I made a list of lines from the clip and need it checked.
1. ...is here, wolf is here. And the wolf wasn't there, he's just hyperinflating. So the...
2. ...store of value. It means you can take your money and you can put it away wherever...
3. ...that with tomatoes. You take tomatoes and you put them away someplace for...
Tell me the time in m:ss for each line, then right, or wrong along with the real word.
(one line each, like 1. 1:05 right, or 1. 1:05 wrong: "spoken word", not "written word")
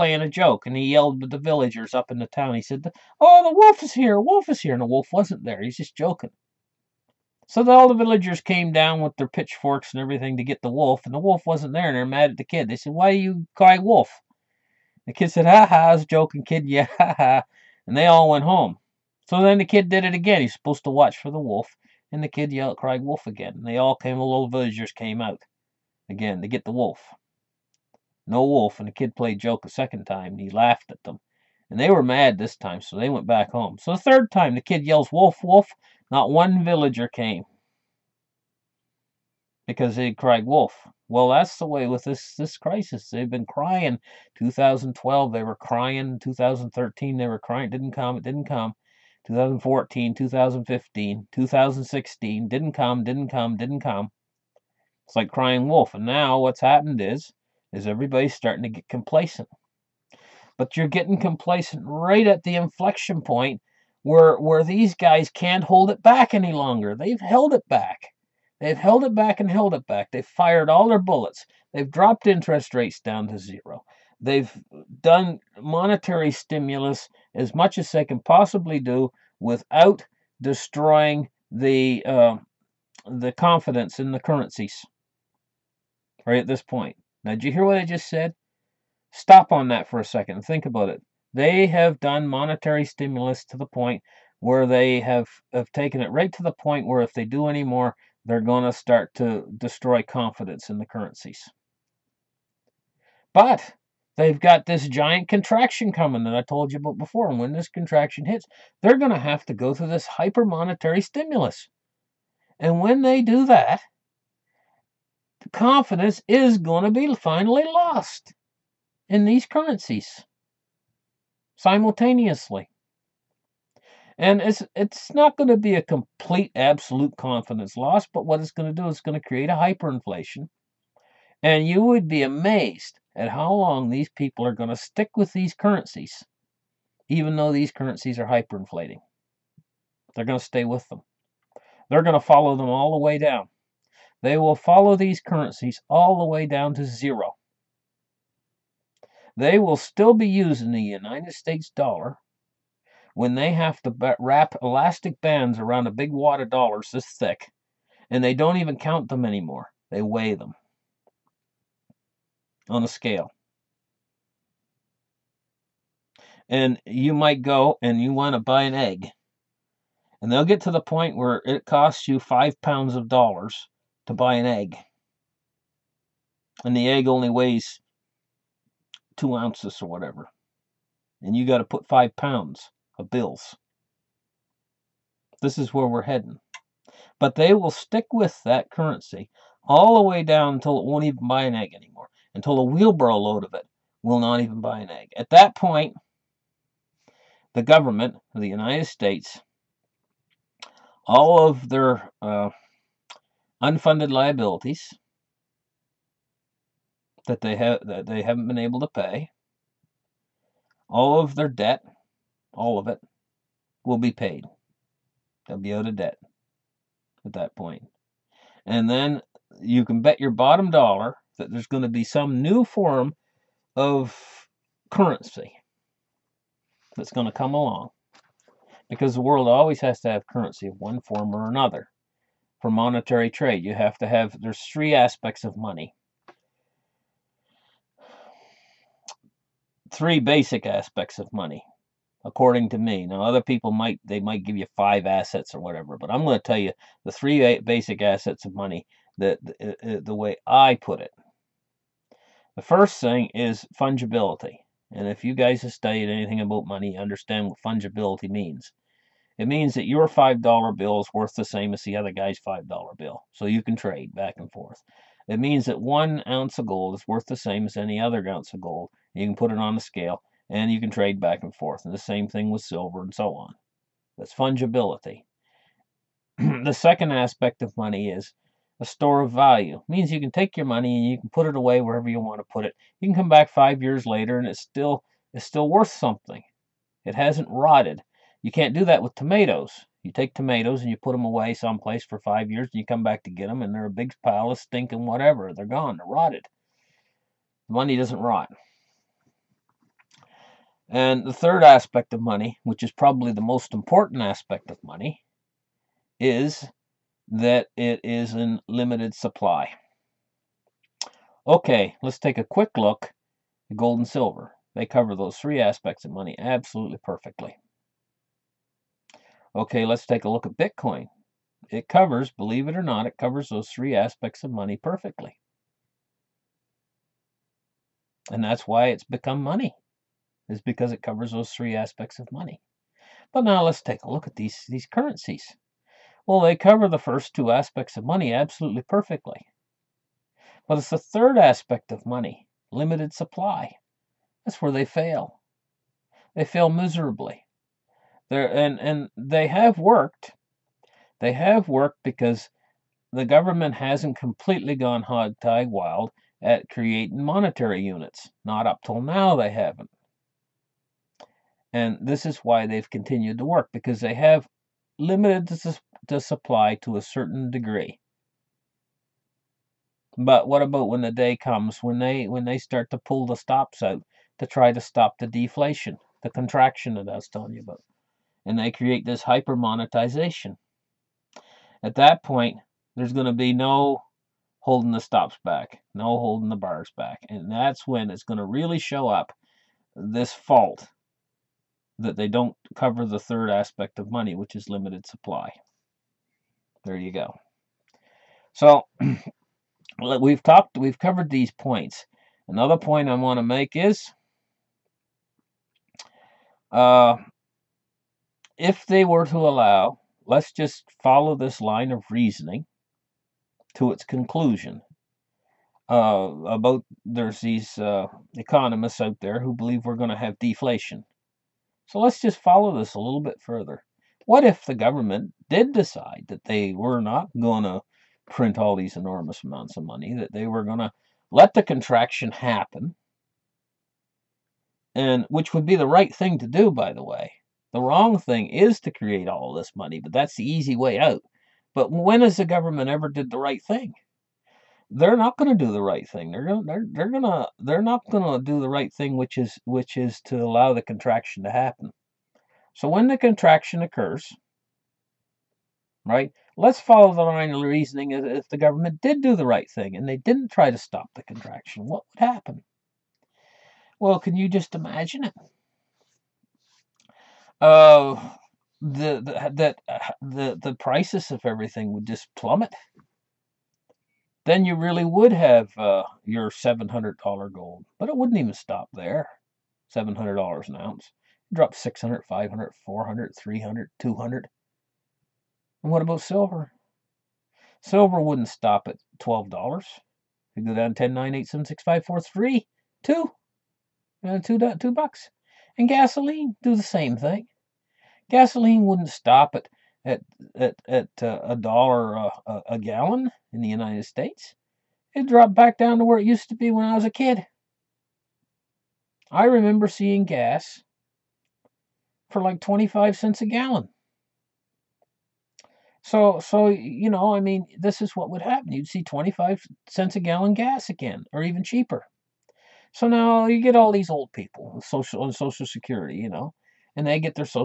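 1. 0:03 wrong: "joking", not "hyperinflating"
2. 4:38 right
3. 4:48 right.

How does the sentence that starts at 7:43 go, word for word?
Well, can you just imagine it?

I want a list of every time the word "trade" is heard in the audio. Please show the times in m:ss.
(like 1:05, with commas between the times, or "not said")
3:53, 4:23, 4:30.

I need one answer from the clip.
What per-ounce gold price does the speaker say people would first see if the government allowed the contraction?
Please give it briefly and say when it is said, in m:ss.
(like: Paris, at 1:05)
$700, at 7:56.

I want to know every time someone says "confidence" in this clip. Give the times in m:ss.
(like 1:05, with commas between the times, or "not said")
1:23, 1:40, 1:55, 2:07.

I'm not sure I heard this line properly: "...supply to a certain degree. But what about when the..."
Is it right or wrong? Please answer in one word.
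right.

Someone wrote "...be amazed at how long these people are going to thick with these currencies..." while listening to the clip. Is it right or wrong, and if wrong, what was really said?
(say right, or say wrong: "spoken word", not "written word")
wrong: "stick", not "thick".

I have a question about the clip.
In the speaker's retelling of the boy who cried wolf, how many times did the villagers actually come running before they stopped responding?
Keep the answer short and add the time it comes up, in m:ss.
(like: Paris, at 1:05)
2, at 0:29.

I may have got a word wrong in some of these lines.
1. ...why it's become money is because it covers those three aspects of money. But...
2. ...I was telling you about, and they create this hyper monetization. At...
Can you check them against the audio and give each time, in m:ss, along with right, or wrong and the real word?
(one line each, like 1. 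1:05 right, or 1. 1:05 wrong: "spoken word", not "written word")
1. 5:28 right
2. 6:17 right.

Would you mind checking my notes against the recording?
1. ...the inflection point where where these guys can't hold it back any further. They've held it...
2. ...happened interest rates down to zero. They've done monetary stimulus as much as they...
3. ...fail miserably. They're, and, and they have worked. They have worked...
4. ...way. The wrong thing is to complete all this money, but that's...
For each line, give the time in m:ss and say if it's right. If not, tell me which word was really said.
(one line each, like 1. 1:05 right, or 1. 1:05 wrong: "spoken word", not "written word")
1. 1:02 wrong: "longer", not "further"
2. 1:11 wrong: "dropped", not "happened"
3. 5:46 right
4. 7:17 wrong: "create", not "complete".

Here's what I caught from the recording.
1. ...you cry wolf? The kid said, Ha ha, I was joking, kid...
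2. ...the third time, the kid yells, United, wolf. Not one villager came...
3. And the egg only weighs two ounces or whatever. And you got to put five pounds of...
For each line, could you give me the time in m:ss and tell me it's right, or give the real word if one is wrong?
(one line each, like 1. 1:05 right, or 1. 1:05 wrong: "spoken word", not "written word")
1. 0:13 right
2. 0:33 wrong: "Wolf", not "United"
3. 2:56 right.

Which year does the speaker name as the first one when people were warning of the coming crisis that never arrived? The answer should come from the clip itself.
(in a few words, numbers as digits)
2012.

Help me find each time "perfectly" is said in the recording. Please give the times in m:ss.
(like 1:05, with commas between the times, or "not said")
5:16, 5:24, 5:38.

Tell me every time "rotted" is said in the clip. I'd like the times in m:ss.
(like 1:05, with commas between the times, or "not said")
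4:47, 4:56.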